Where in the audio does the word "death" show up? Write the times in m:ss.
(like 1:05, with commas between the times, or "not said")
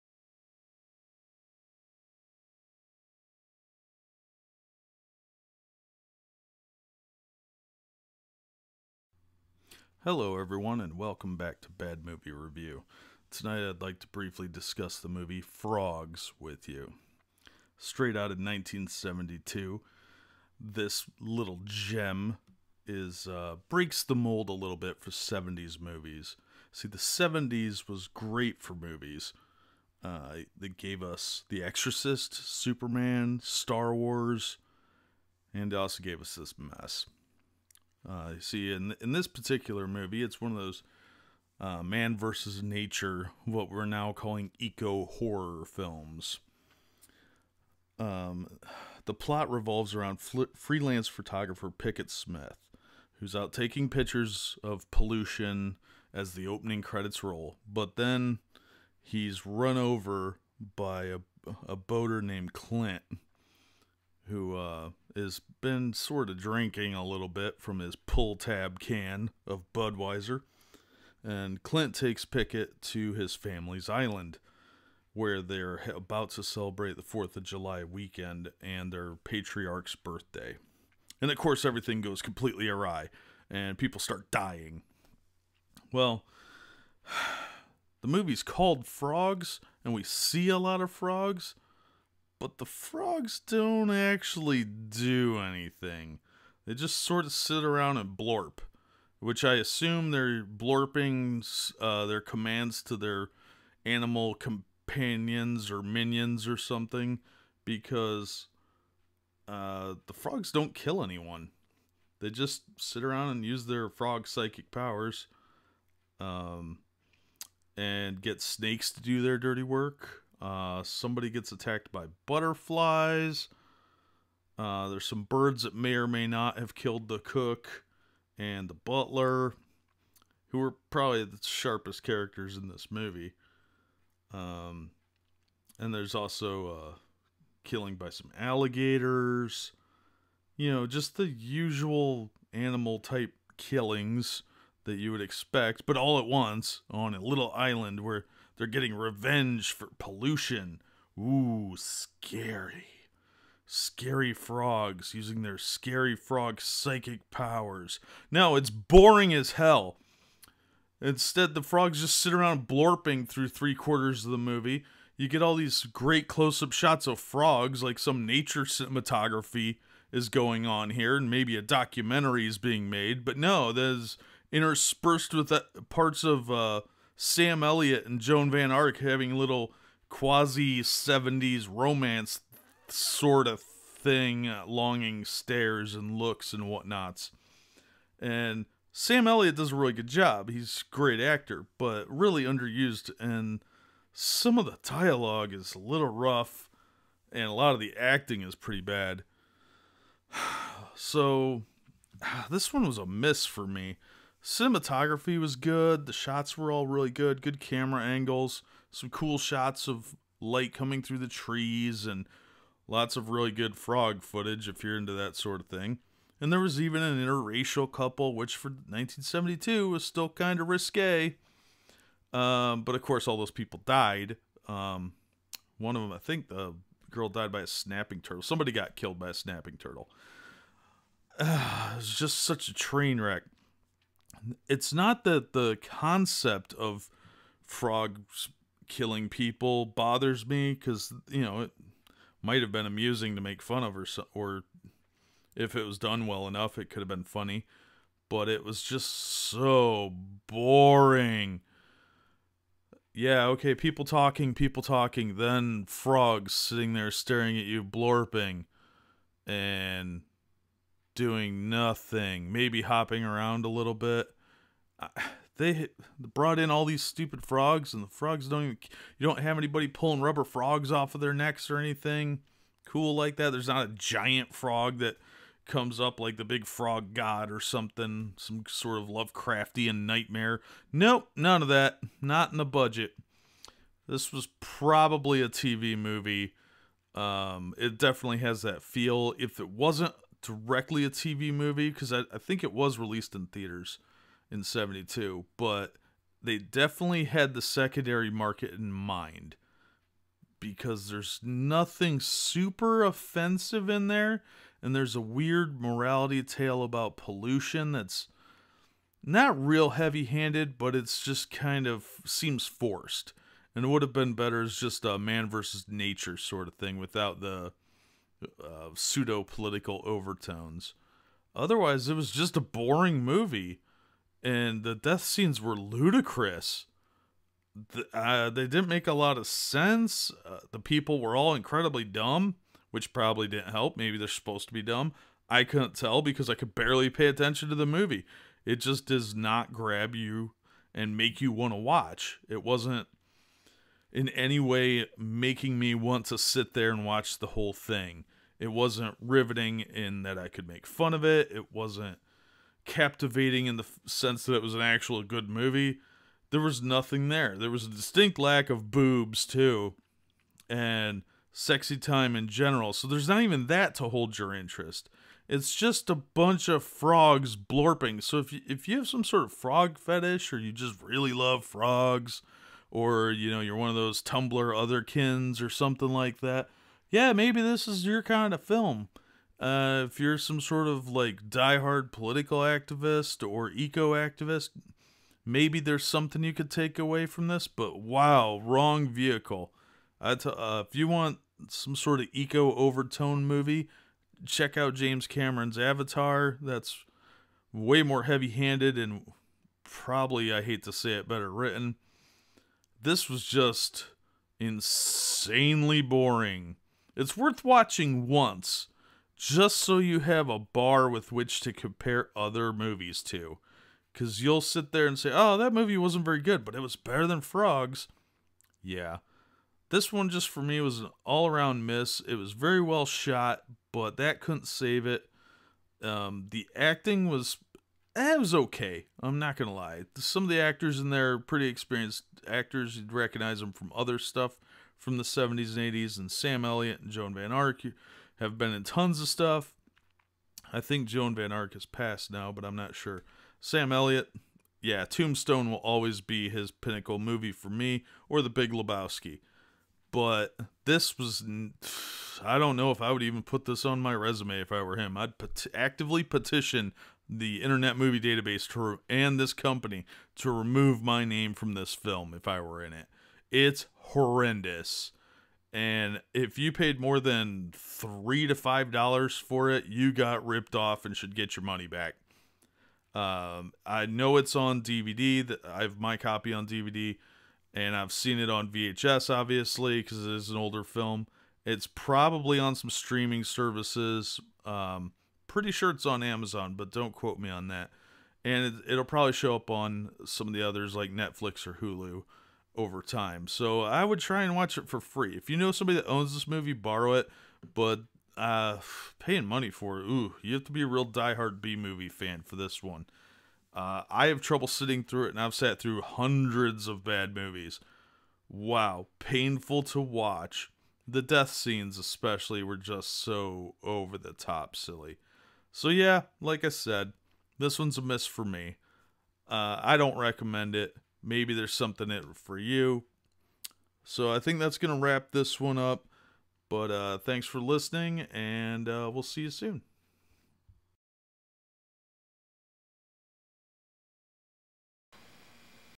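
5:24, 8:31.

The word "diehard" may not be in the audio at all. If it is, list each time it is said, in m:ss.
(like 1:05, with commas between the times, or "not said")
6:21, 8:21.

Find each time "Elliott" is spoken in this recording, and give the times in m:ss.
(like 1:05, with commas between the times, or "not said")
2:57, 3:09, 7:16, 7:23.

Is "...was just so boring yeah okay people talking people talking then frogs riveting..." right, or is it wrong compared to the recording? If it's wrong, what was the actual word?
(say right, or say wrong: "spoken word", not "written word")
wrong: "sitting", not "riveting".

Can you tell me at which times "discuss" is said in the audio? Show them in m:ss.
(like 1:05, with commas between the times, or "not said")
0:14.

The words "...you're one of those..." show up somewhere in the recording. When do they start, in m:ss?
6:13.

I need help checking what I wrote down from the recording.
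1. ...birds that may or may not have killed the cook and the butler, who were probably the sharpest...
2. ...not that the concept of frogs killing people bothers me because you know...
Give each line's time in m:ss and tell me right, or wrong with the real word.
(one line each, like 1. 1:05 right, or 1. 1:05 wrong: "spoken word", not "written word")
1. 2:05 right
2. 3:54 right.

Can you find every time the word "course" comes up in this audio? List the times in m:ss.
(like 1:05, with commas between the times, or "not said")
1:21, 3:43.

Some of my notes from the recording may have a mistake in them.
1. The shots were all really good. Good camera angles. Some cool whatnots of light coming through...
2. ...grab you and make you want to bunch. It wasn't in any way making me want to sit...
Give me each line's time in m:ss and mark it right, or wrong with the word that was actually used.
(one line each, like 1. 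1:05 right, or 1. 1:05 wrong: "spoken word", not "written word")
1. 3:26 wrong: "shots", not "whatnots"
2. 5:39 wrong: "watch", not "bunch".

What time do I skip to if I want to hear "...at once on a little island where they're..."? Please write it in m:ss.
2:26.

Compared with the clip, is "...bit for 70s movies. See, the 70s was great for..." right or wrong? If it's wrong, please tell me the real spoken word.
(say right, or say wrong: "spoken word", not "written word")
right.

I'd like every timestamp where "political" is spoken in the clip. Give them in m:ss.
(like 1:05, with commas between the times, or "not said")
5:19, 6:22.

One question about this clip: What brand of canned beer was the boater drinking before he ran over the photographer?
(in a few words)
Budweiser.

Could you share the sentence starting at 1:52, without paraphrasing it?
They just sit around and use their frog psychic powers um, and get snakes to do their dirty work.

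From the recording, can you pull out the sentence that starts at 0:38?
Uh, see, in in this particular movie, it's one of those uh, man versus nature, what we're now calling eco horror films.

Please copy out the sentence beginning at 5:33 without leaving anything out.
Maybe they're supposed to be dumb.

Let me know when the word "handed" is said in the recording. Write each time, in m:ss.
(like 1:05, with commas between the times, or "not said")
5:09, 6:38.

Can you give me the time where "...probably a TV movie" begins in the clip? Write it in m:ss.
4:44.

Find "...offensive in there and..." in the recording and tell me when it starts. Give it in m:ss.
5:03.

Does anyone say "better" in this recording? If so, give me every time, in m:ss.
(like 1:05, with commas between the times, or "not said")
5:14, 6:41, 6:56.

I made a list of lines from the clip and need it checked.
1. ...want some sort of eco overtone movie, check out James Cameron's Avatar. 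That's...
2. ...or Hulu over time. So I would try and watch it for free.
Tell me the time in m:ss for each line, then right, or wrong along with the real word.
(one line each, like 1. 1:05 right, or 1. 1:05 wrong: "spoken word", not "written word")
1. 6:31 right
2. 8:11 right.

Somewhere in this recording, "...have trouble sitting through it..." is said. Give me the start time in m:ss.
8:24.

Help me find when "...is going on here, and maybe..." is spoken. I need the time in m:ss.
2:50.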